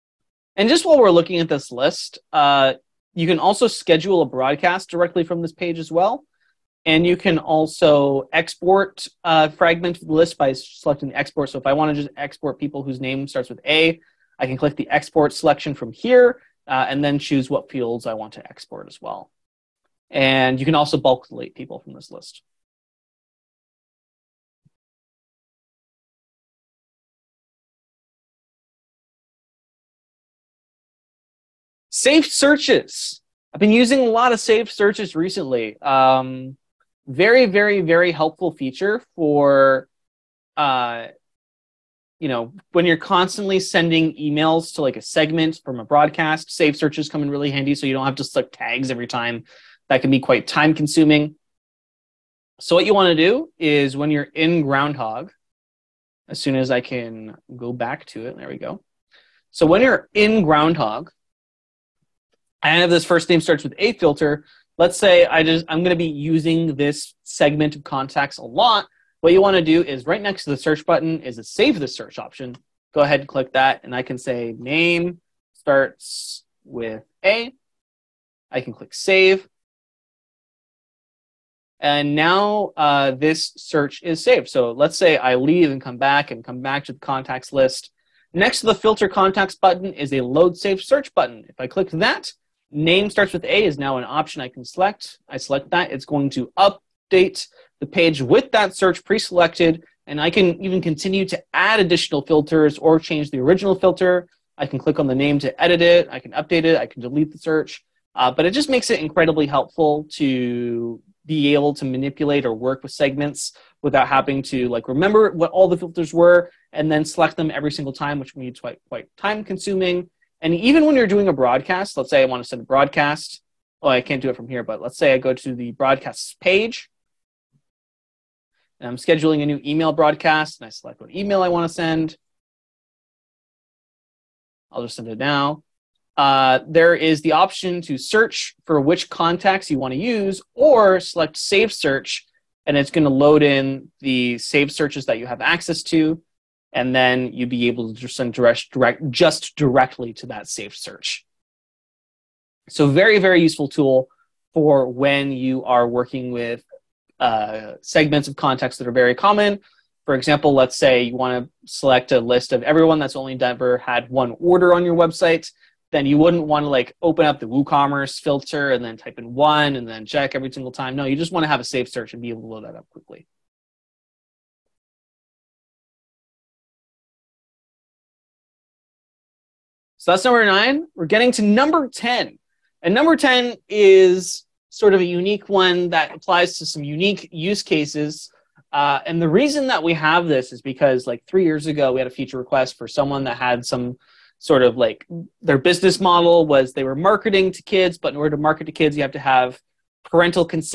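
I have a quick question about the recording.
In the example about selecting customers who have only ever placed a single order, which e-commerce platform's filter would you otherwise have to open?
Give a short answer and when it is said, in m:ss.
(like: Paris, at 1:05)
WooCommerce, at 2:47.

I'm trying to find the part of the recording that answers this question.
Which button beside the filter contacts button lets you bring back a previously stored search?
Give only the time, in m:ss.
1:30.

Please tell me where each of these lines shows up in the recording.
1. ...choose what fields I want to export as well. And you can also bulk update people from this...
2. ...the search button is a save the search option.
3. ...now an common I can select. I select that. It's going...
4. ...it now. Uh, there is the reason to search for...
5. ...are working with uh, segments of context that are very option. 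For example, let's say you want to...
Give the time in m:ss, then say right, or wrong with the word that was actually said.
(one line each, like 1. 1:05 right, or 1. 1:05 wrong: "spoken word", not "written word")
1. 0:17 wrong: "delete", not "update"
2. 1:10 right
3. 1:33 wrong: "option", not "common"
4. 2:15 wrong: "option", not "reason"
5. 2:35 wrong: "common", not "option".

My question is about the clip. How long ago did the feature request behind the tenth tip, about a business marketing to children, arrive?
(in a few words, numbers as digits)
3 years.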